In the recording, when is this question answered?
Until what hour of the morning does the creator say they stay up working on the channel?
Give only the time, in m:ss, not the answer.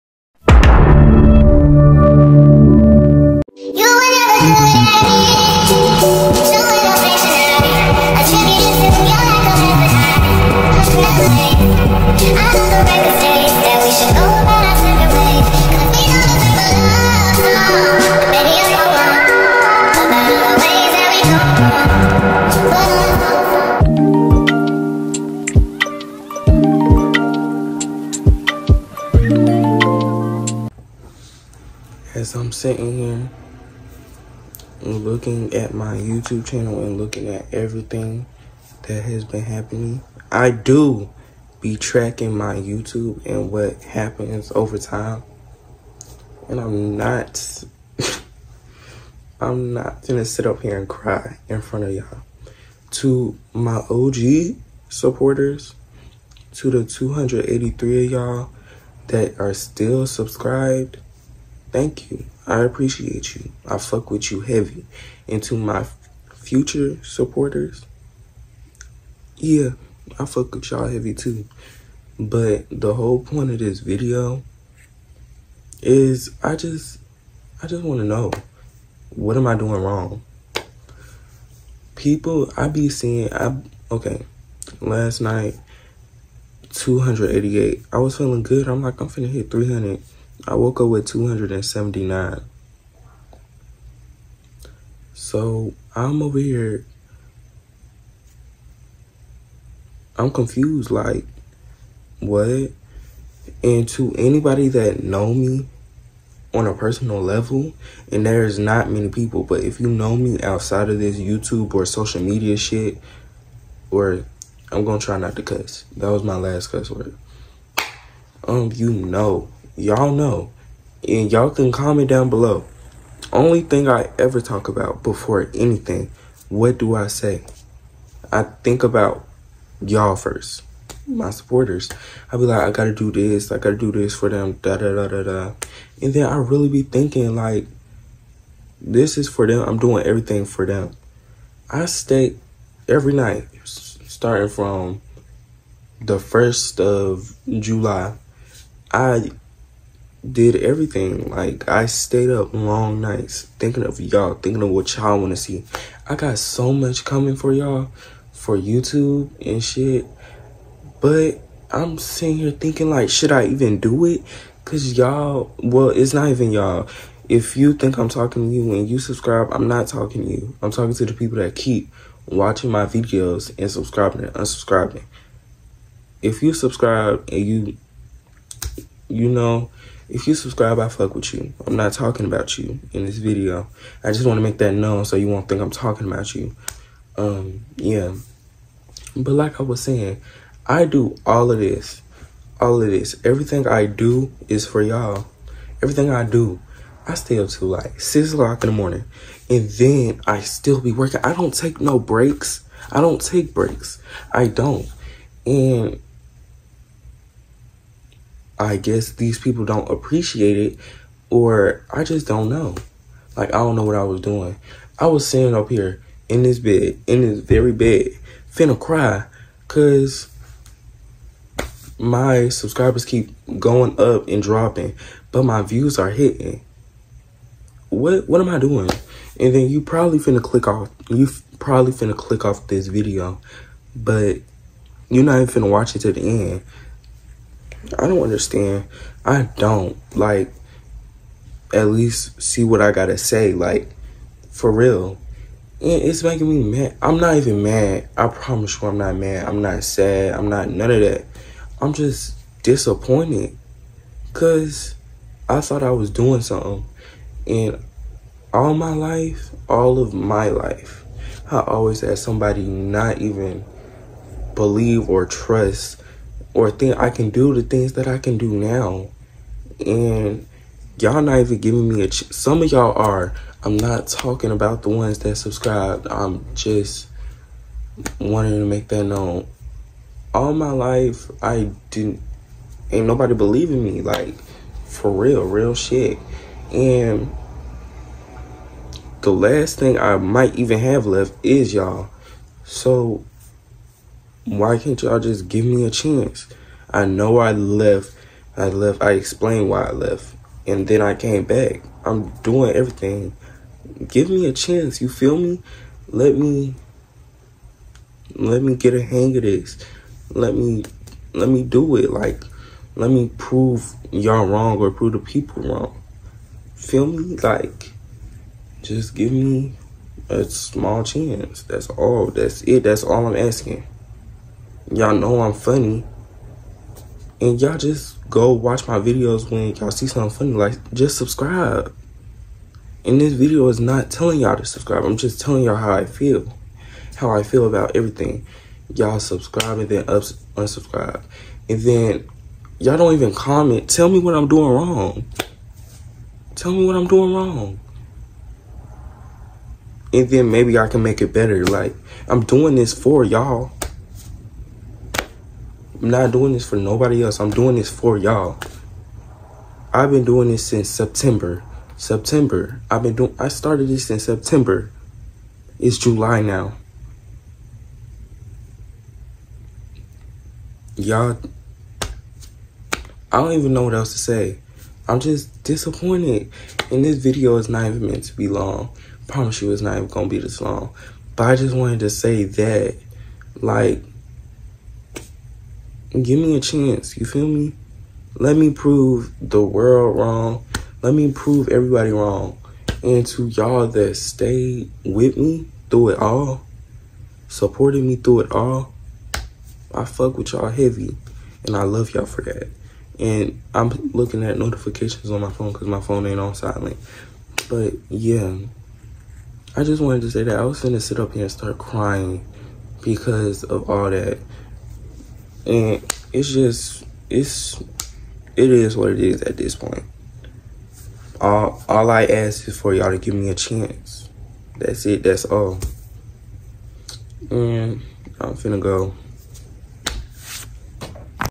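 3:18.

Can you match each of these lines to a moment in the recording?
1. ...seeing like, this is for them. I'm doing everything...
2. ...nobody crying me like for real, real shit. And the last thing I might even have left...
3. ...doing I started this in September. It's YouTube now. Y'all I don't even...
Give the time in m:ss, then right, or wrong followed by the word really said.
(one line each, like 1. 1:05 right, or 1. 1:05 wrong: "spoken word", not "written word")
1. 2:16 wrong: "thinking", not "seeing"
2. 4:43 wrong: "believing", not "crying"
3. 6:03 wrong: "July", not "YouTube".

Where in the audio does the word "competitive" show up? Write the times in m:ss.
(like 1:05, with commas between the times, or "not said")
not said.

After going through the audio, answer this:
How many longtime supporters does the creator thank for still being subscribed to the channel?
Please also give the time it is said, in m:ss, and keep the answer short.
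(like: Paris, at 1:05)
283, at 0:56.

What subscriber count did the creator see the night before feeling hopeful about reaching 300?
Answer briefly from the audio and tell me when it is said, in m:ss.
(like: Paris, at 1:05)
288, at 1:26.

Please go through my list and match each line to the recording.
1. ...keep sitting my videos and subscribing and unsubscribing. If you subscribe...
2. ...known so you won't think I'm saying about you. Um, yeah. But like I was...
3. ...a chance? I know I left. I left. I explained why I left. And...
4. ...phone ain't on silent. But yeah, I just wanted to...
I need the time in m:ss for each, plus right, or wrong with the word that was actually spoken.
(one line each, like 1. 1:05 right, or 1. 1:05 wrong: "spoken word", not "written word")
1. 2:51 wrong: "watching", not "sitting"
2. 3:04 wrong: "talking", not "saying"
3. 4:55 right
4. 6:46 right.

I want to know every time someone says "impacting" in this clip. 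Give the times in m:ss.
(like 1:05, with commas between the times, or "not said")
not said.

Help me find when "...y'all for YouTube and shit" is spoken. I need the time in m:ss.
2:37.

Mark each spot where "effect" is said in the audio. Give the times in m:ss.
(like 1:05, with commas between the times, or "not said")
not said.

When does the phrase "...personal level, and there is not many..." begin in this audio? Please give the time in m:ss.
1:46.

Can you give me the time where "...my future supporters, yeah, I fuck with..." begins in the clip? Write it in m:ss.
1:05.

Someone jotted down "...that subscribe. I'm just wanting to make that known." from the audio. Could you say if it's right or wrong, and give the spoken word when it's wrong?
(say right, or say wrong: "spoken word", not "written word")
right.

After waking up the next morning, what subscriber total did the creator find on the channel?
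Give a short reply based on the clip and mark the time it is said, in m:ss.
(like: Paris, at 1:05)
279, at 1:31.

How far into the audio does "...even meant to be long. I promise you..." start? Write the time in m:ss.
6:17.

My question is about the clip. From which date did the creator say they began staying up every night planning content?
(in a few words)
the first of July.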